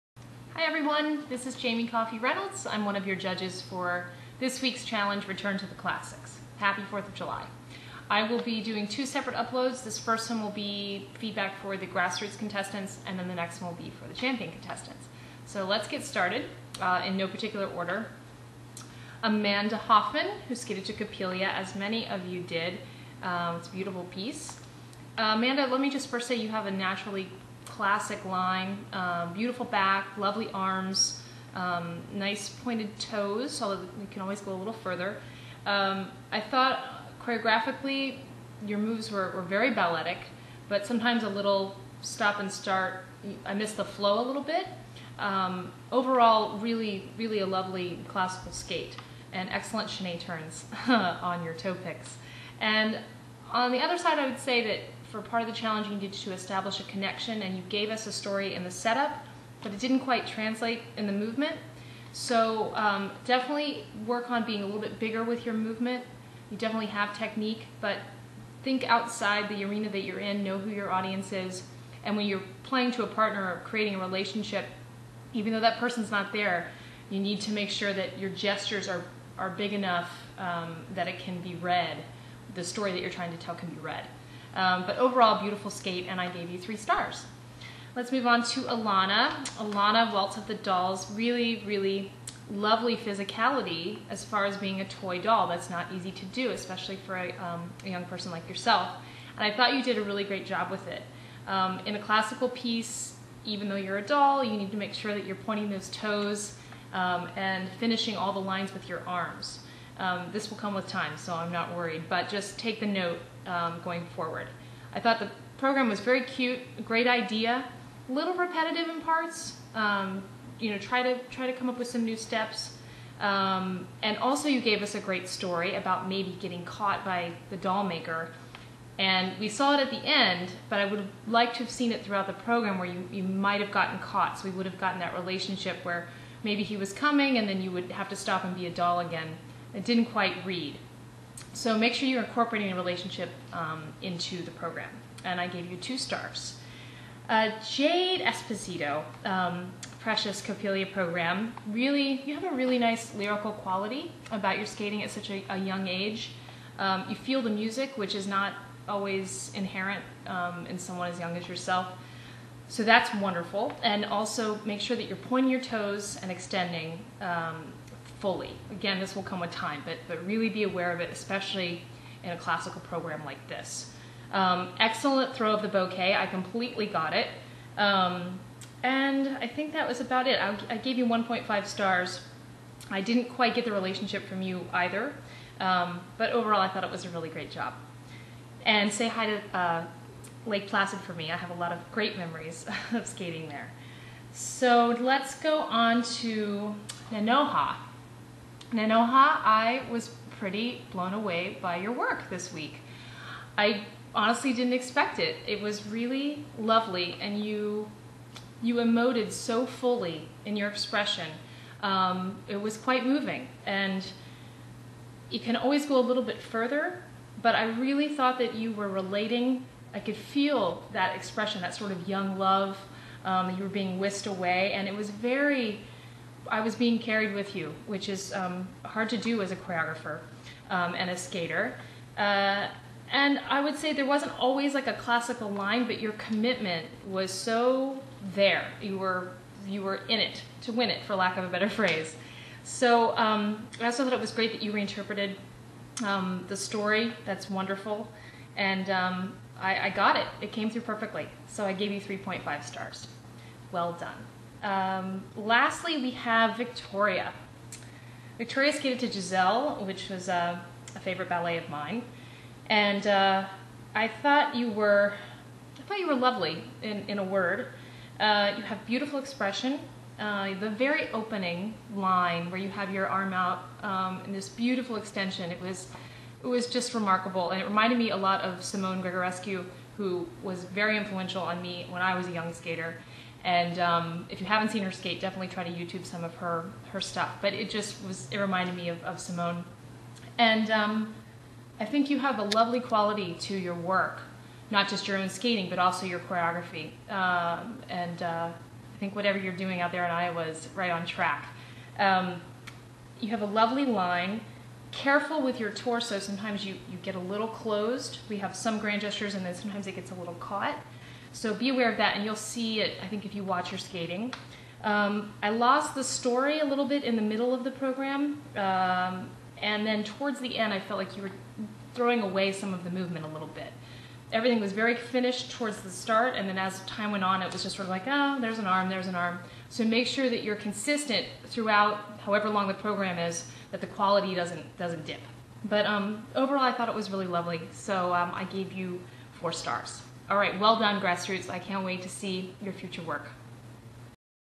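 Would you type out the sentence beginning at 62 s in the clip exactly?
So um, definitely work on being a little bit bigger with your movement.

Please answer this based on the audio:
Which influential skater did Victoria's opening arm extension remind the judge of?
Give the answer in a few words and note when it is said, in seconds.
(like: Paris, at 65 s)
Simone Gregorescu, at 278 s.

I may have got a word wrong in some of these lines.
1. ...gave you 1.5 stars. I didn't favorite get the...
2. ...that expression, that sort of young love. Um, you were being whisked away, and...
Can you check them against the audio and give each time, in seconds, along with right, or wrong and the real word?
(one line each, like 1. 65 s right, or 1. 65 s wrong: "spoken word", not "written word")
1. 180 s wrong: "quite", not "favorite"
2. 220 s right.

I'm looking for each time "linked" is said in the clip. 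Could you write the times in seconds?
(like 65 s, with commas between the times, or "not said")
not said.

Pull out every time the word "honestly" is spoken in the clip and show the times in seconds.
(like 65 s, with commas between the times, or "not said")
204 s.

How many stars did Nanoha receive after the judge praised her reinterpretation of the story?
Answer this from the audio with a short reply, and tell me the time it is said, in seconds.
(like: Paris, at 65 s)
3.5, at 252 s.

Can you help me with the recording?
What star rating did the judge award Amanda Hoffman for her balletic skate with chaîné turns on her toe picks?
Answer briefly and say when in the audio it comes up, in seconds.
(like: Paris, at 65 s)
3, at 86 s.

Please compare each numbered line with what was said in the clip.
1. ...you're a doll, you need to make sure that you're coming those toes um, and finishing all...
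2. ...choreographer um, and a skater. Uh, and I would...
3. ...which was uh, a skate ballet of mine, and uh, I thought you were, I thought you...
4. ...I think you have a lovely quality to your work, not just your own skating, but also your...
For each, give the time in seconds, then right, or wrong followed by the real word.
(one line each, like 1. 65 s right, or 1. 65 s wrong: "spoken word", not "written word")
1. 103 s wrong: "pointing", not "coming"
2. 229 s right
3. 259 s wrong: "favorite", not "skate"
4. 291 s right.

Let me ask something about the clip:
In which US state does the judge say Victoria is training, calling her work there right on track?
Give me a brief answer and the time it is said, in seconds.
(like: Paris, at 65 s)
Iowa, at 300 s.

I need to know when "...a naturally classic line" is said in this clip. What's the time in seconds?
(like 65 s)
26 s.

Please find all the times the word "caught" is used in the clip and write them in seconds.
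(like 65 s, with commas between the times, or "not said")
126 s, 133 s, 310 s.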